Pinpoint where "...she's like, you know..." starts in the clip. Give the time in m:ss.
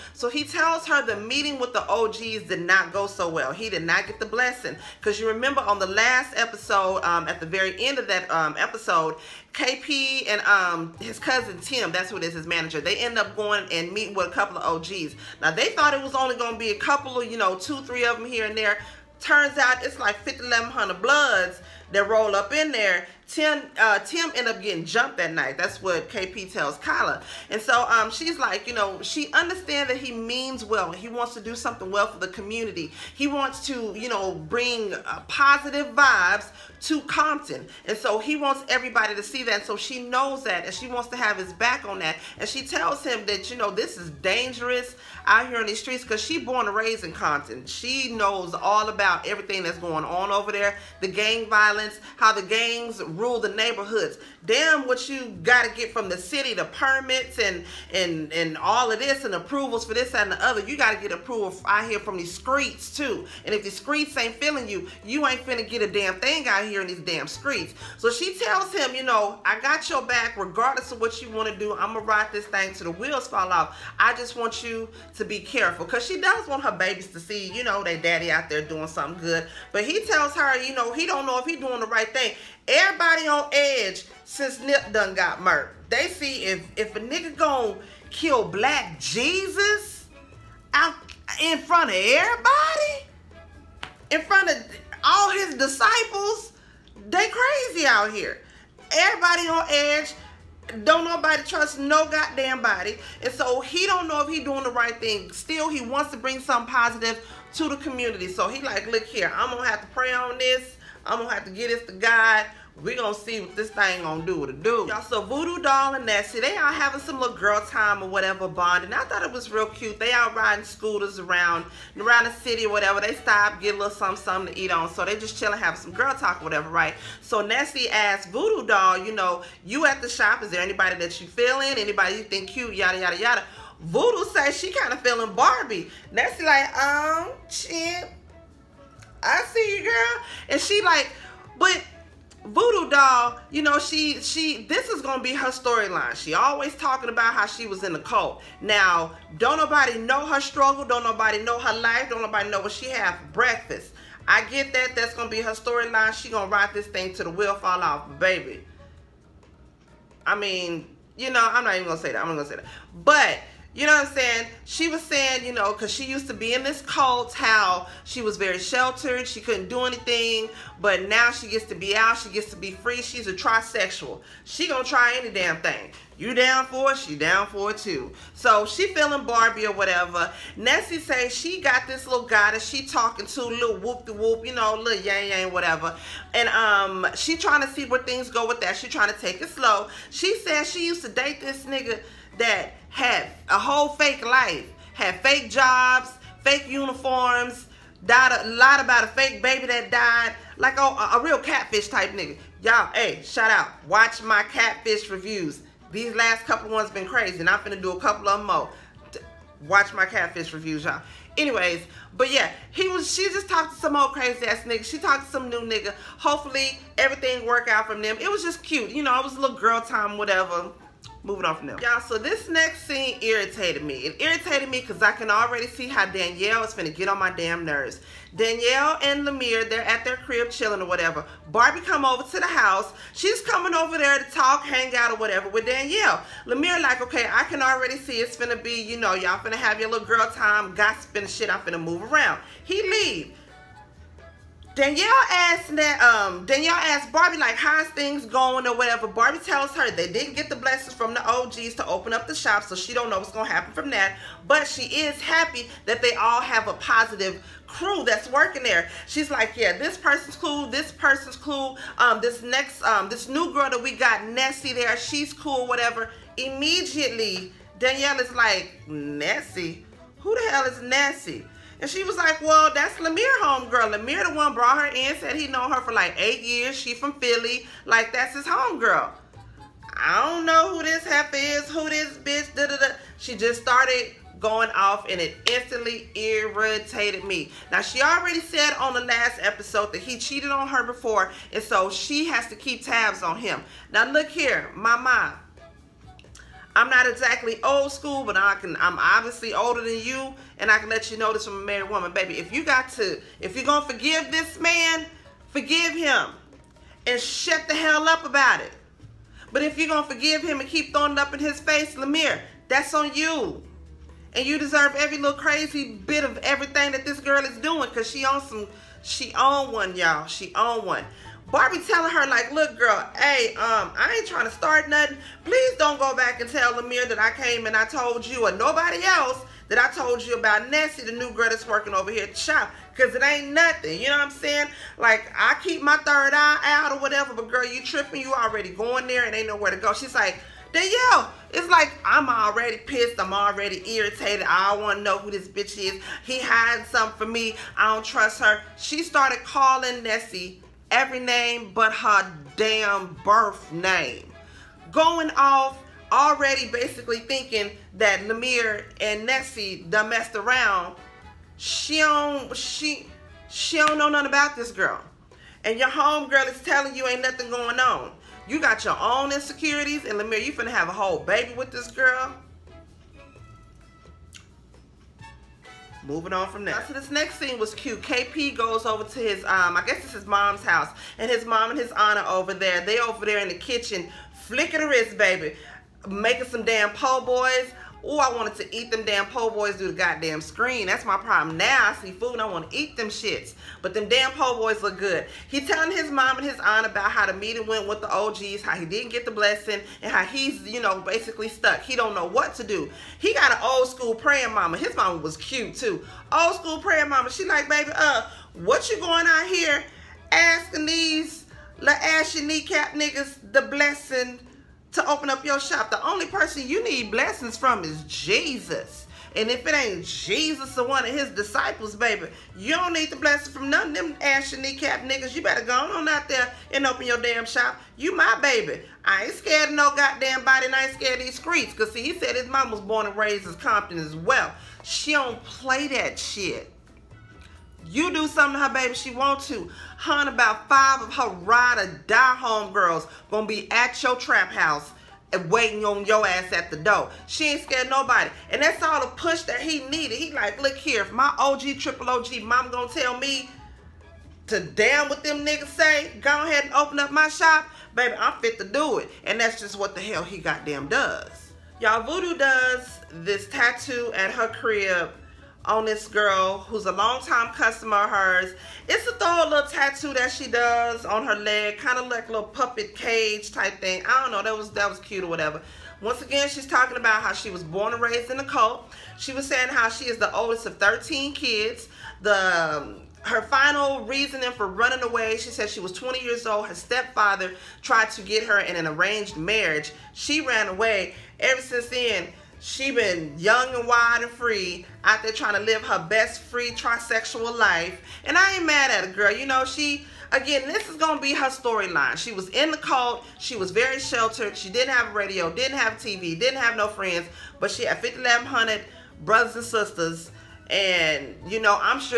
0:28.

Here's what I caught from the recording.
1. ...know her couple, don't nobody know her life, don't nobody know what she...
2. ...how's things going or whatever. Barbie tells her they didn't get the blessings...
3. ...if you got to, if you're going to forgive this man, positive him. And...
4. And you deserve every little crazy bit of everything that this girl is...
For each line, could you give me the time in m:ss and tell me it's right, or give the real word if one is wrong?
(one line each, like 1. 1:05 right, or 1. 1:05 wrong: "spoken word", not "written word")
1. 2:29 wrong: "struggle", not "couple"
2. 4:07 right
3. 5:02 wrong: "forgive", not "positive"
4. 5:14 right.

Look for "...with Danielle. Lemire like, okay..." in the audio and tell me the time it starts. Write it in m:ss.
3:55.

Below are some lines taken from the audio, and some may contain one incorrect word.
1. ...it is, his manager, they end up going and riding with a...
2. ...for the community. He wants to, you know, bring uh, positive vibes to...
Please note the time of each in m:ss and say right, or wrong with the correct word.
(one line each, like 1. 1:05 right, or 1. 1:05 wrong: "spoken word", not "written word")
1. 0:12 wrong: "meeting", not "riding"
2. 0:32 right.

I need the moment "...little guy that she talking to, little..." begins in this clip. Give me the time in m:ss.
3:02.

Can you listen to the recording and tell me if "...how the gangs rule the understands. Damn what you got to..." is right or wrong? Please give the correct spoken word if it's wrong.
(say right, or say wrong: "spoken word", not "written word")
wrong: "neighborhoods", not "understands".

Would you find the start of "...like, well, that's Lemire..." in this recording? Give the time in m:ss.
4:32.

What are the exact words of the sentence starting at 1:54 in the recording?
Y'all, so Vudu Dahl and Nessie, they all having some little girl time or whatever bonding.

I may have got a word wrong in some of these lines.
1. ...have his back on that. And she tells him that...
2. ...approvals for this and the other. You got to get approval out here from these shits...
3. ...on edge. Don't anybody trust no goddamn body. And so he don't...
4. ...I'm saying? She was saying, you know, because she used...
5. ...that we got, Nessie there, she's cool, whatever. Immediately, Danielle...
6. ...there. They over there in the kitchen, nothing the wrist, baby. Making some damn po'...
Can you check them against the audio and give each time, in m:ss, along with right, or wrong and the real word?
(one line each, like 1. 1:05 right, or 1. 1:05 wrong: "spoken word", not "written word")
1. 0:41 right
2. 0:59 wrong: "streets", not "shits"
3. 1:39 wrong: "nobody", not "anybody"
4. 2:44 right
5. 4:23 right
6. 6:22 wrong: "flicking", not "nothing".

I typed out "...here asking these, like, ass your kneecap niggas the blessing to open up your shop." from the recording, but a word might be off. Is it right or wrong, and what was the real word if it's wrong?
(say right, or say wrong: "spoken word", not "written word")
right.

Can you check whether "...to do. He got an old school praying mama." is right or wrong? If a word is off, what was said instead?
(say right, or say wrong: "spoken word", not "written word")
right.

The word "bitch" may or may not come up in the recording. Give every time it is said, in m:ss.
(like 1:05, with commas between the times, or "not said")
4:42, 5:45.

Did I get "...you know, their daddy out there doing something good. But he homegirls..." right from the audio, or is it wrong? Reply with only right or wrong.
wrong.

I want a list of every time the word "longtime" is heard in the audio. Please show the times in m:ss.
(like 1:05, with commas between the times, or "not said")
7:46.